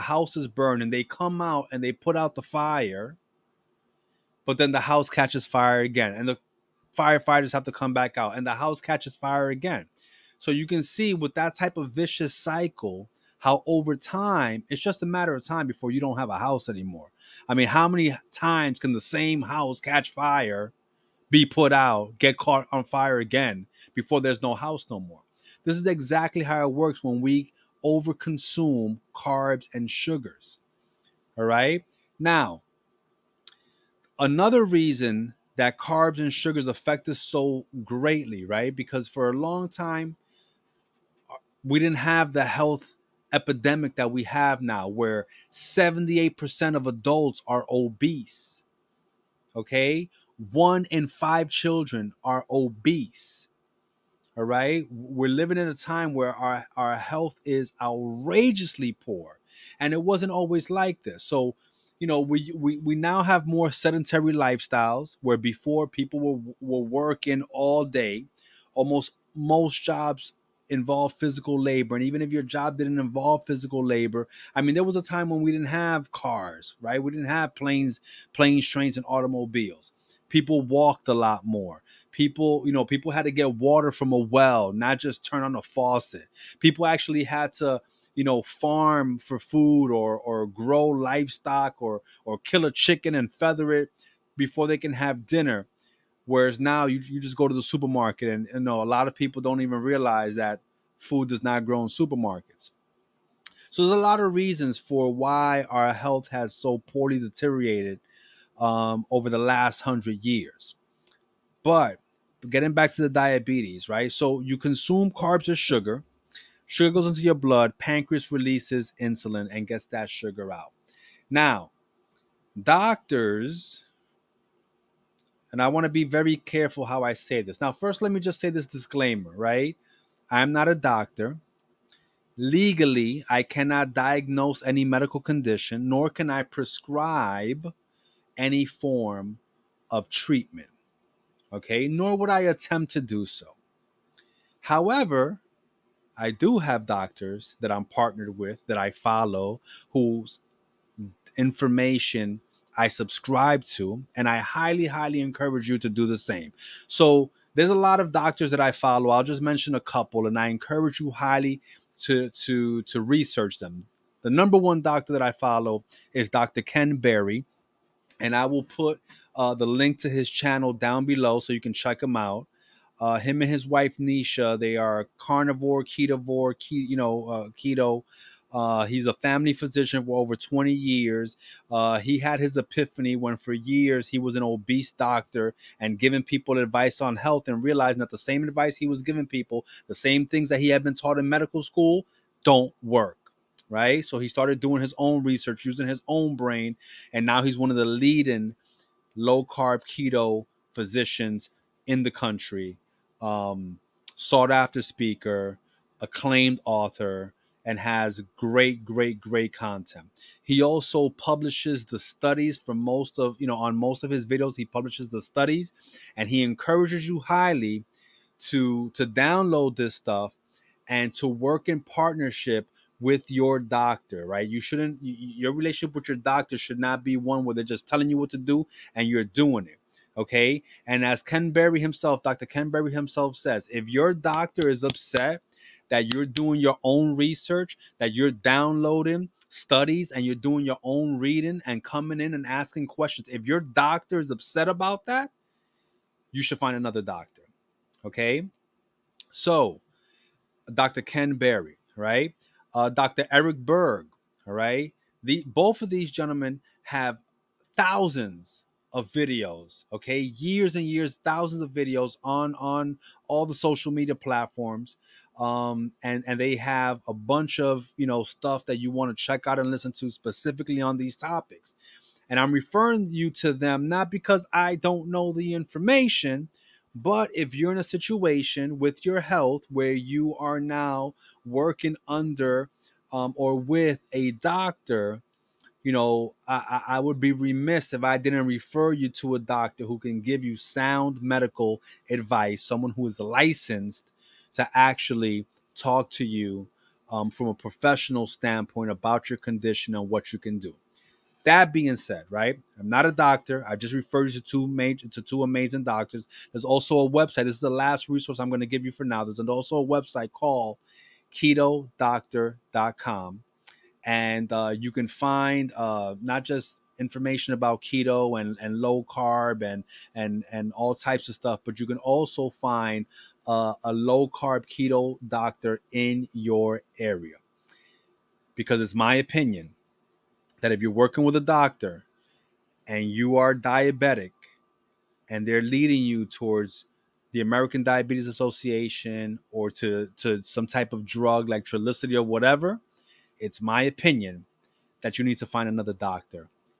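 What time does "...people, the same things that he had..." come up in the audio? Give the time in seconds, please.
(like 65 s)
189 s.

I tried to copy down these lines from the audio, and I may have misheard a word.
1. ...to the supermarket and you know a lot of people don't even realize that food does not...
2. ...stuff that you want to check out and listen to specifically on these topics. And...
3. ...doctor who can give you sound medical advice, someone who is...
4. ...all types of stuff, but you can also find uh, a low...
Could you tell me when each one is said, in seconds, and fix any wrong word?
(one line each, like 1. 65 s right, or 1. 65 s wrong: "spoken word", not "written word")
1. 97 s right
2. 268 s right
3. 289 s right
4. 320 s right.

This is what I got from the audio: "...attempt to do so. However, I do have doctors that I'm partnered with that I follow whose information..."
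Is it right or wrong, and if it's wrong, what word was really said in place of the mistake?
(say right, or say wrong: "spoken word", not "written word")
right.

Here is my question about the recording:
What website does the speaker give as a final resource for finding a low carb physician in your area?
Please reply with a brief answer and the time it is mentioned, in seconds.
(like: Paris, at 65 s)
ketodoctor.com, at 311 s.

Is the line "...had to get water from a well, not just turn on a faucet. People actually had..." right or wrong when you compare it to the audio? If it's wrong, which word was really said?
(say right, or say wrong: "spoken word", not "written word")
right.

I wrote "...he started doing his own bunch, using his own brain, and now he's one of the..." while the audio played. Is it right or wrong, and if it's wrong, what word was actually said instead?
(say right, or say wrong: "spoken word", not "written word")
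wrong: "research", not "bunch".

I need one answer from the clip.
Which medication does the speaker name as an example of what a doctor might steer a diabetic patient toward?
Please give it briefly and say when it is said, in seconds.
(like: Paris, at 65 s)
Trulicity, at 341 s.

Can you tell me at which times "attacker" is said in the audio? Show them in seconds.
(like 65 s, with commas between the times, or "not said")
not said.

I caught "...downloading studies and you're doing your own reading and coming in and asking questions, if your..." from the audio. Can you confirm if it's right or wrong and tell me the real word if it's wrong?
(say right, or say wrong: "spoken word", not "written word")
right.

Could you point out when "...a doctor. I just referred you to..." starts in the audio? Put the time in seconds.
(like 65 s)
303 s.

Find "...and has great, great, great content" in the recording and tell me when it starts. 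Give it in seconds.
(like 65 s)
207 s.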